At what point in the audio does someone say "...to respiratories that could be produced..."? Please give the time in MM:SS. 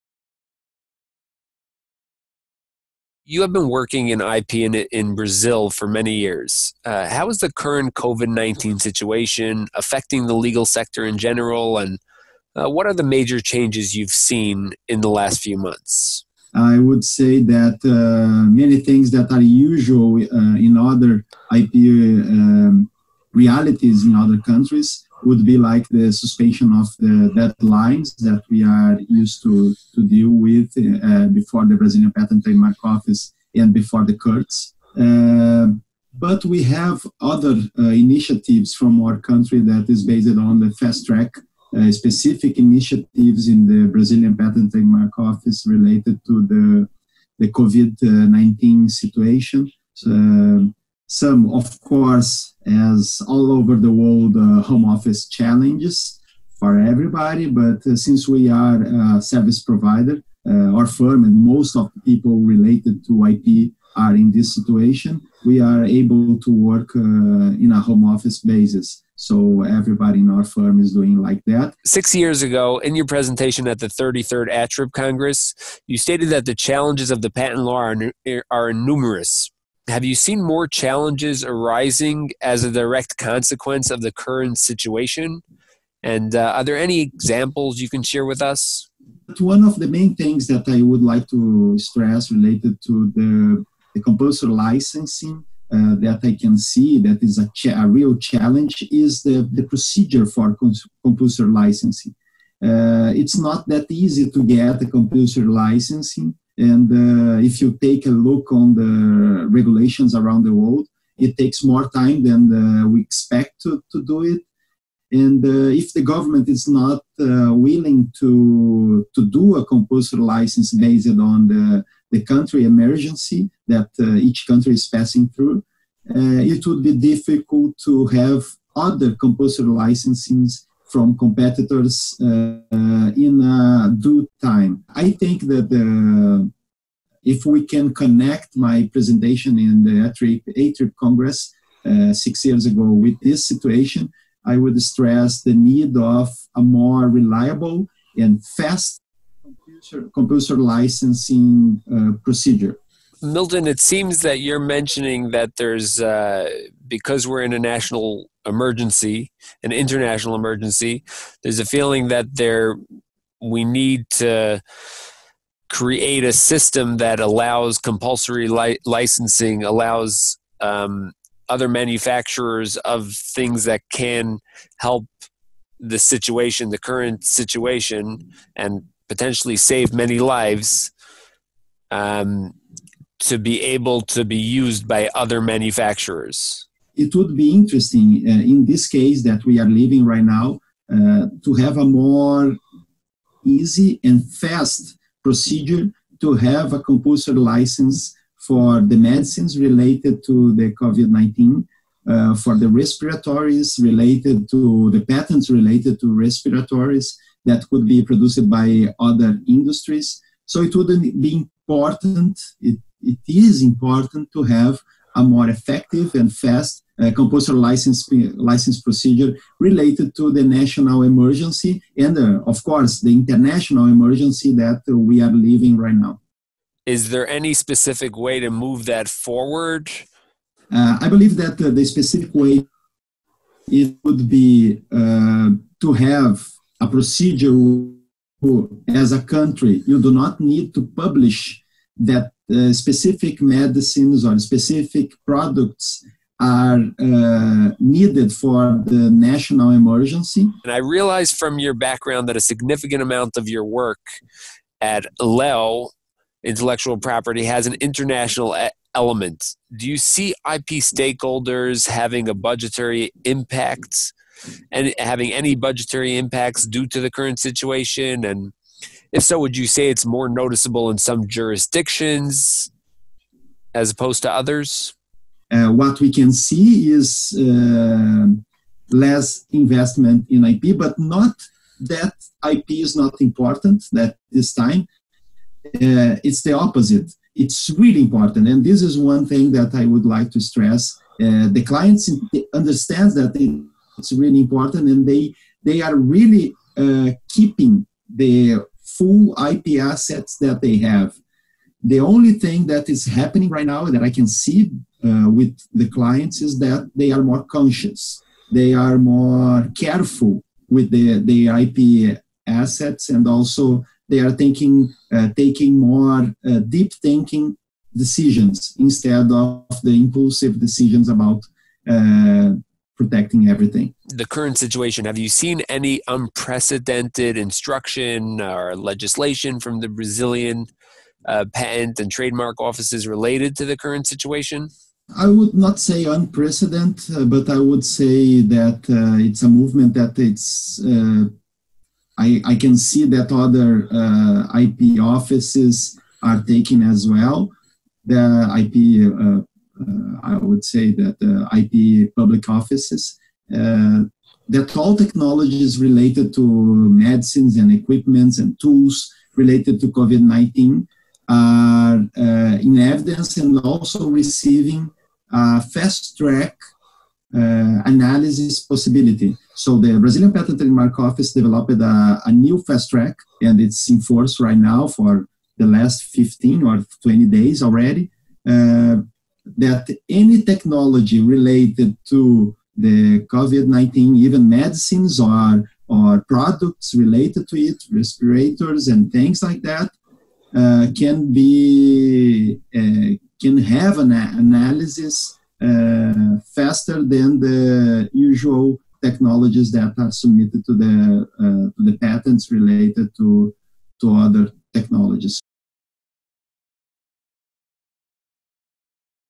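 03:25.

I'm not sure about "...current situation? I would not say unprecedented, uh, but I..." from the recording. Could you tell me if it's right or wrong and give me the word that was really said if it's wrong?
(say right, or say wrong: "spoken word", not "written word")
right.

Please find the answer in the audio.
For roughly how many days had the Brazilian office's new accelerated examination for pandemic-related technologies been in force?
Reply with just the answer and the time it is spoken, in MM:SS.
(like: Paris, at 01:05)
15 or 20 days, at 06:16.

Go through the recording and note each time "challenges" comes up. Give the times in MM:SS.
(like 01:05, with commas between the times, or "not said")
00:55, 01:16, 01:20, 01:38.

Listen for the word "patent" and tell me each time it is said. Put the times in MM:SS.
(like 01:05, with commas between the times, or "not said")
00:32, 00:44, 01:17, 03:25, 05:31, 06:10, 06:41.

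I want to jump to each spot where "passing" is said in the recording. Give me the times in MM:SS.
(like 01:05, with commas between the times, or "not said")
02:04.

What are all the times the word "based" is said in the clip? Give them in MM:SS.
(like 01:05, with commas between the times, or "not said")
00:40, 02:00.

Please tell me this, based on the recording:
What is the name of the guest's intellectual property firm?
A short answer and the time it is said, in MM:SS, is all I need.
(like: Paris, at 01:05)
Leão, at 04:15.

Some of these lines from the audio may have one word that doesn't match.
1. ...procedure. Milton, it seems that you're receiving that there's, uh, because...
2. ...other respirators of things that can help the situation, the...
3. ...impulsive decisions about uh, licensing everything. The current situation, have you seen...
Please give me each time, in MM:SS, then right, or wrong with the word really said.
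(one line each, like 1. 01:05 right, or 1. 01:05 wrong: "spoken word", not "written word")
1. 02:32 wrong: "mentioning", not "receiving"
2. 02:51 wrong: "manufacturers", not "respirators"
3. 05:20 wrong: "protecting", not "licensing".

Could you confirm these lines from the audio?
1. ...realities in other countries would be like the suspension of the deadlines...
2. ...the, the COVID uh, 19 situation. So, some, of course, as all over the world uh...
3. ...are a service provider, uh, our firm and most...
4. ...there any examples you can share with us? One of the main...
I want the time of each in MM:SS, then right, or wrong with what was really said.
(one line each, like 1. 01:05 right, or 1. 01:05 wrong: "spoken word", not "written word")
1. 00:23 right
2. 00:46 right
3. 00:58 right
4. 01:26 right.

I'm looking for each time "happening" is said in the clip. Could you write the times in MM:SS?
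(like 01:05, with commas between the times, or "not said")
05:03.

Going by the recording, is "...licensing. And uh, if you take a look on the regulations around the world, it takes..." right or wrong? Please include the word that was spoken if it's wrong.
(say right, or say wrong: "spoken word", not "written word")
right.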